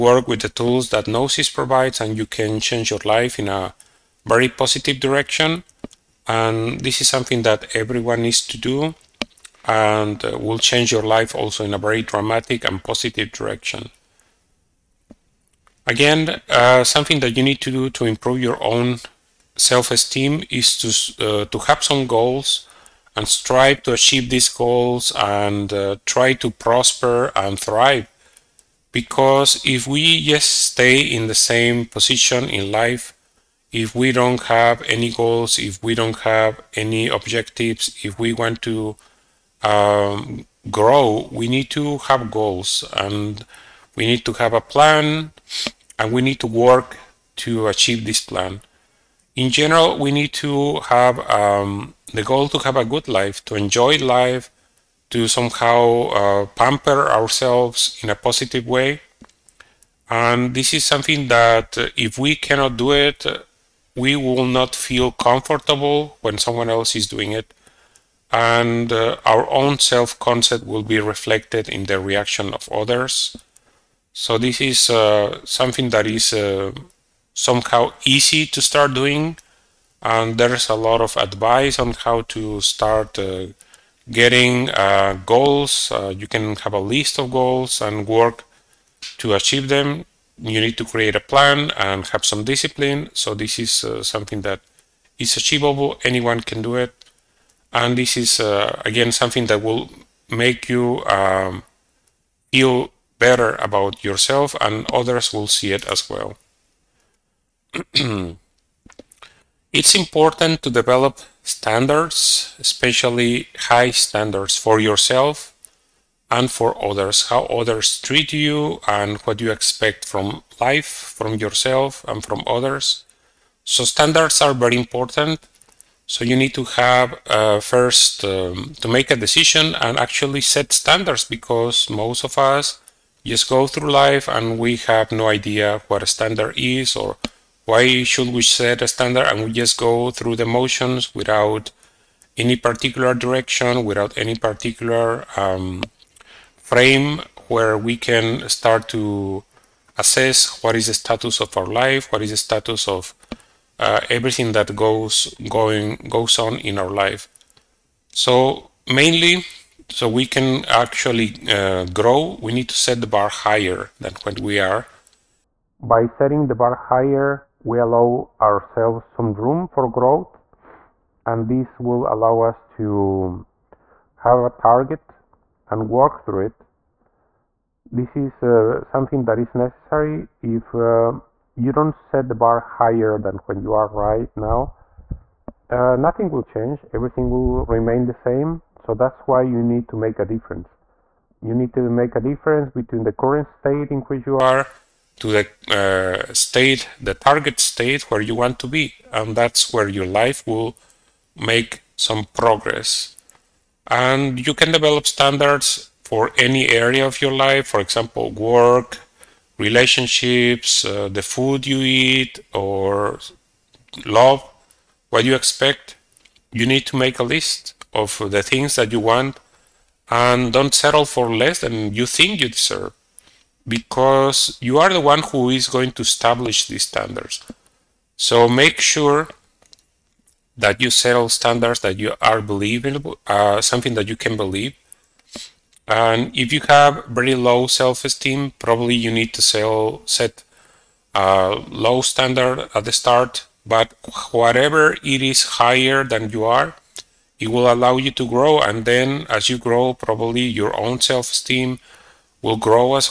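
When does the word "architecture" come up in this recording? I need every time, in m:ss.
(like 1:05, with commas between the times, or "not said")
not said.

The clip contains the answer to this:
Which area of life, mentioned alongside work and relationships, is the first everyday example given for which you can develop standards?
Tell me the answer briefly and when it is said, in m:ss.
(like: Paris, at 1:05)
the food you eat, at 3:31.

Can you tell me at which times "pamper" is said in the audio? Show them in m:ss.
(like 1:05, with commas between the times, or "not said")
0:56.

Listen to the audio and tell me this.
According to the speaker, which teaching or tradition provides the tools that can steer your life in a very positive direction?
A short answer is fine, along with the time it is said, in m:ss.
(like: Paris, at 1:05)
Gnosis, at 0:01.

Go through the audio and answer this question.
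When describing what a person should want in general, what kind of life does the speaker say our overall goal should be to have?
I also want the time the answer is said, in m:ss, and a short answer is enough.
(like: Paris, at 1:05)
a good life, at 0:52.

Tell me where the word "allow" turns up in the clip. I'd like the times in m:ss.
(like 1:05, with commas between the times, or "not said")
2:47, 2:52, 4:07.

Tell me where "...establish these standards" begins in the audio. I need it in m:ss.
3:46.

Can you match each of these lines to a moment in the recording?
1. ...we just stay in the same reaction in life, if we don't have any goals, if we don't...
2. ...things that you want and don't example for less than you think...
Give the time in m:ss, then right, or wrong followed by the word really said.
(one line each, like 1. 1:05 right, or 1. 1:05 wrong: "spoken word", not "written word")
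1. 0:29 wrong: "position", not "reaction"
2. 3:38 wrong: "settle", not "example".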